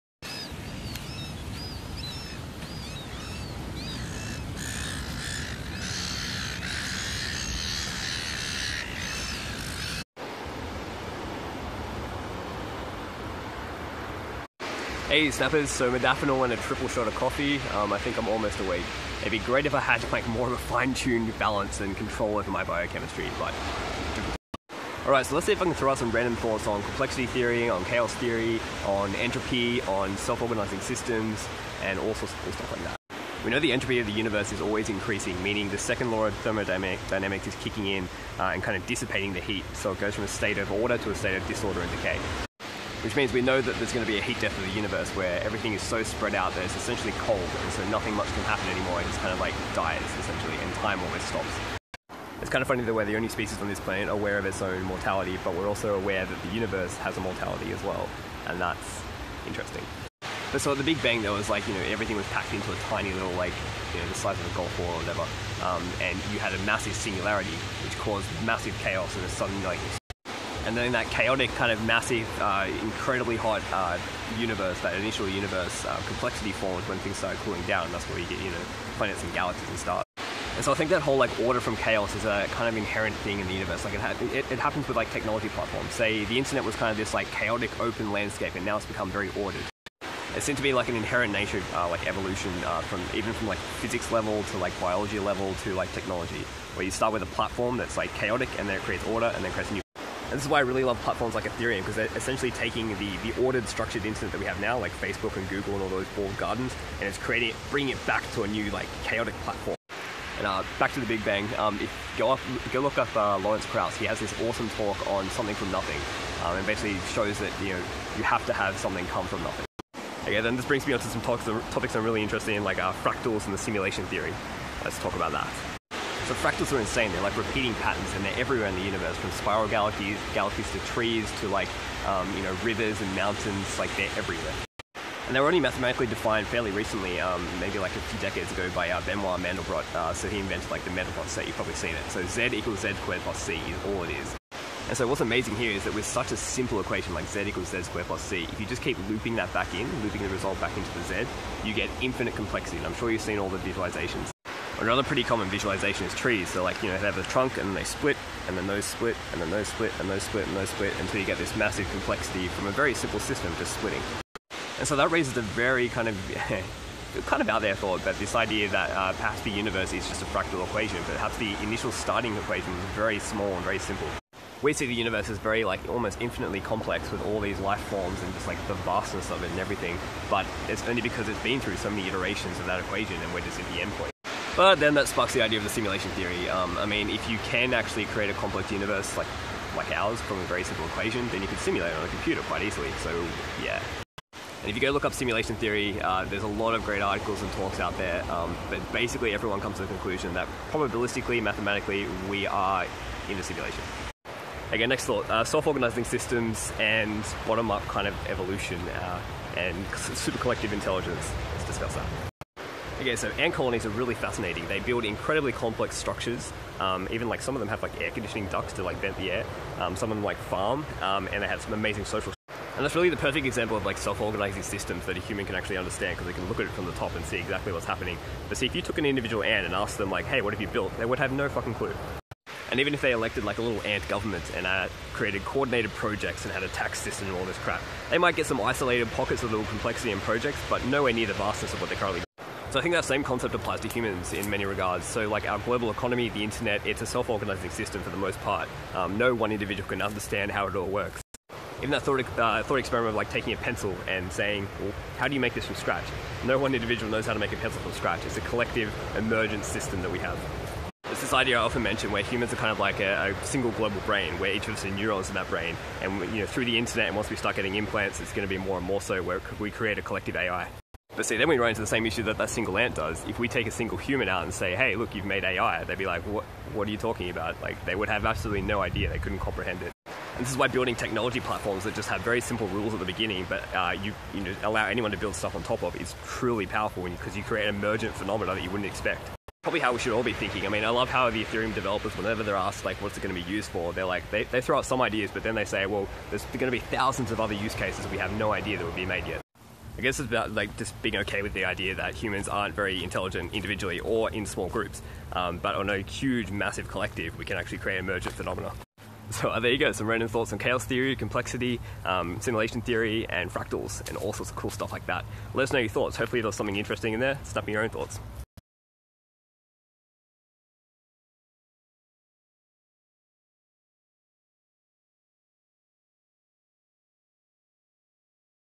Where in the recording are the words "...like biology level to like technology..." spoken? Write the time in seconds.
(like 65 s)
94 s.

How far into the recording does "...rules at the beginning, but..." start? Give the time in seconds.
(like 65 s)
282 s.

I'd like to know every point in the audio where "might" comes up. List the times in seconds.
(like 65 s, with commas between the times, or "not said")
238 s.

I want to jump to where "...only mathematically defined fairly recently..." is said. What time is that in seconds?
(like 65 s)
135 s.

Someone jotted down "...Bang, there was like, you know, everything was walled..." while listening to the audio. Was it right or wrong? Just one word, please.
wrong.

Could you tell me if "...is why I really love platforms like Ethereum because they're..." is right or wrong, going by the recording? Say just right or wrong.
right.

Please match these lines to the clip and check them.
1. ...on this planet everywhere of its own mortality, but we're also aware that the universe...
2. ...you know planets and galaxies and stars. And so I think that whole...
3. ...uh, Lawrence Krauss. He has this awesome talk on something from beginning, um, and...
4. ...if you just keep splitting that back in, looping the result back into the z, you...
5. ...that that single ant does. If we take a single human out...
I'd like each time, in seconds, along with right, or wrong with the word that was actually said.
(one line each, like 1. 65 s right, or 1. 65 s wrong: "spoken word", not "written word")
1. 53 s wrong: "aware", not "everywhere"
2. 78 s right
3. 113 s wrong: "nothing", not "beginning"
4. 148 s wrong: "looping", not "splitting"
5. 272 s right.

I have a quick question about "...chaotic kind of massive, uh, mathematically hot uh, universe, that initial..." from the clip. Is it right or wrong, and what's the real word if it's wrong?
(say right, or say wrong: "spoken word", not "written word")
wrong: "incredibly", not "mathematically".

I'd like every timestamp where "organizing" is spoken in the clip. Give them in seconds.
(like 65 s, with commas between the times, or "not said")
30 s, 205 s, 223 s, 247 s.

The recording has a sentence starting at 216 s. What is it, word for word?
Um, even like some of them have like air conditioning ducts to like vent the air.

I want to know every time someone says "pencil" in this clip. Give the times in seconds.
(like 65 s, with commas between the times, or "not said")
253 s, 257 s.